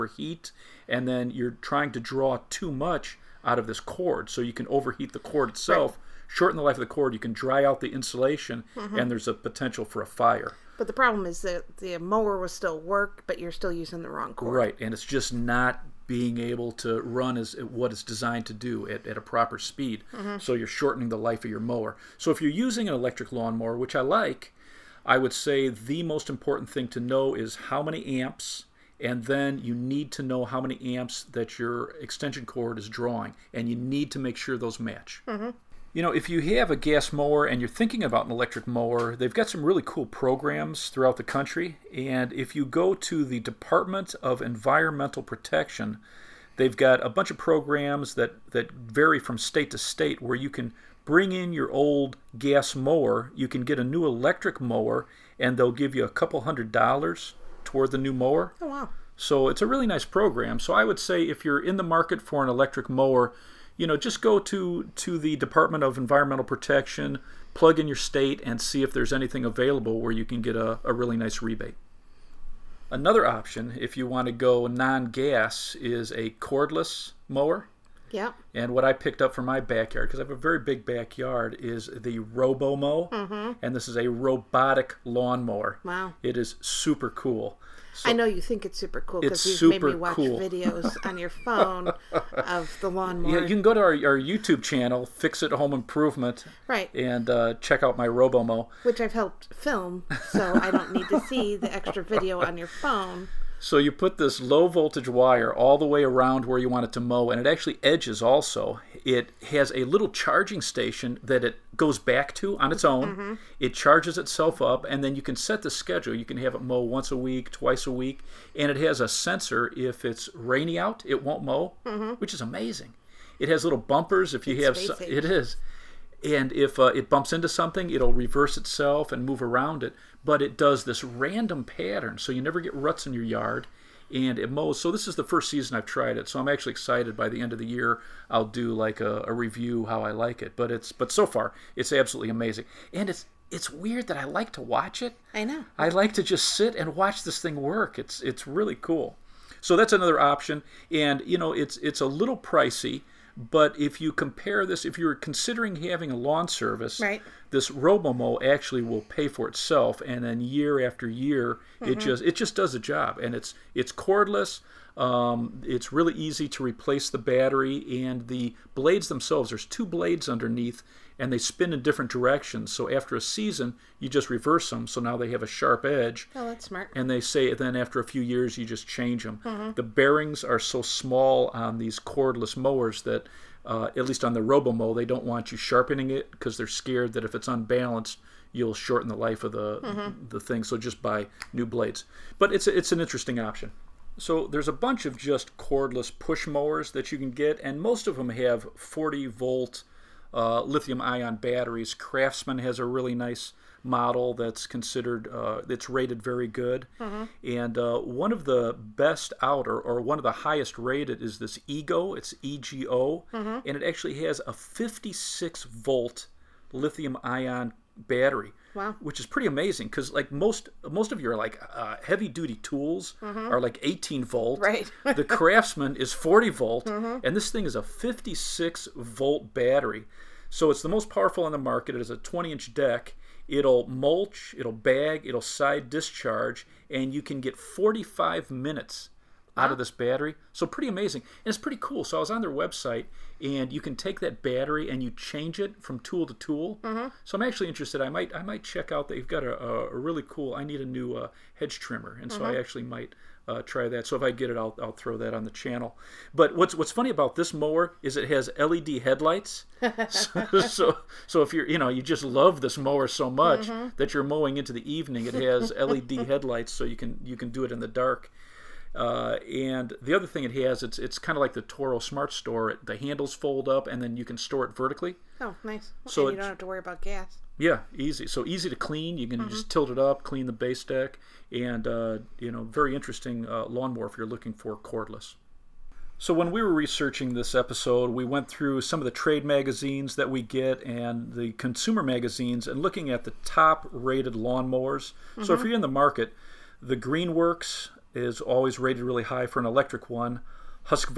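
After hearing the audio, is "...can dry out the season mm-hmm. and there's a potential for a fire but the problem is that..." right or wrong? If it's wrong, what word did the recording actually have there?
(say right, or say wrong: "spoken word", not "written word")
wrong: "insulation", not "season".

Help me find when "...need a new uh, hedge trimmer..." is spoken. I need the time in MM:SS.
04:10.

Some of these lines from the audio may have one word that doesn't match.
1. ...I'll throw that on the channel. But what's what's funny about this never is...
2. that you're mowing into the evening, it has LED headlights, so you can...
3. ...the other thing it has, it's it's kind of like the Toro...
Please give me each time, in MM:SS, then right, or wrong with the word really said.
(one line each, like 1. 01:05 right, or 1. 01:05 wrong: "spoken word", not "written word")
1. 04:14 wrong: "mower", not "never"
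2. 04:23 right
3. 04:29 right.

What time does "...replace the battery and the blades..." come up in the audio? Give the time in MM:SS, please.
02:46.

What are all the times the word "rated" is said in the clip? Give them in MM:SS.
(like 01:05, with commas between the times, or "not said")
03:25, 03:30, 04:53, 04:58.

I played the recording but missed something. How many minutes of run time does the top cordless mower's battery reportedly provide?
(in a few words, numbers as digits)
45 minutes.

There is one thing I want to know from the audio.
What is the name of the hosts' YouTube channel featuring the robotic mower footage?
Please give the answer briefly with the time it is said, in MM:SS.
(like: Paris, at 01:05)
Fix It Home Improvement, at 01:35.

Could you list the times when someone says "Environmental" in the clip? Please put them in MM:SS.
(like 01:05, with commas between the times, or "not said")
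00:44, 01:05.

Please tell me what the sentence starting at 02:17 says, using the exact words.
By the end of the year, I'll do like a, a review how I like it.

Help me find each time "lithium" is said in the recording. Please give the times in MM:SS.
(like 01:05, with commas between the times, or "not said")
03:20, 03:36.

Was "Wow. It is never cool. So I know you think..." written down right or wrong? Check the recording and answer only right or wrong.
wrong.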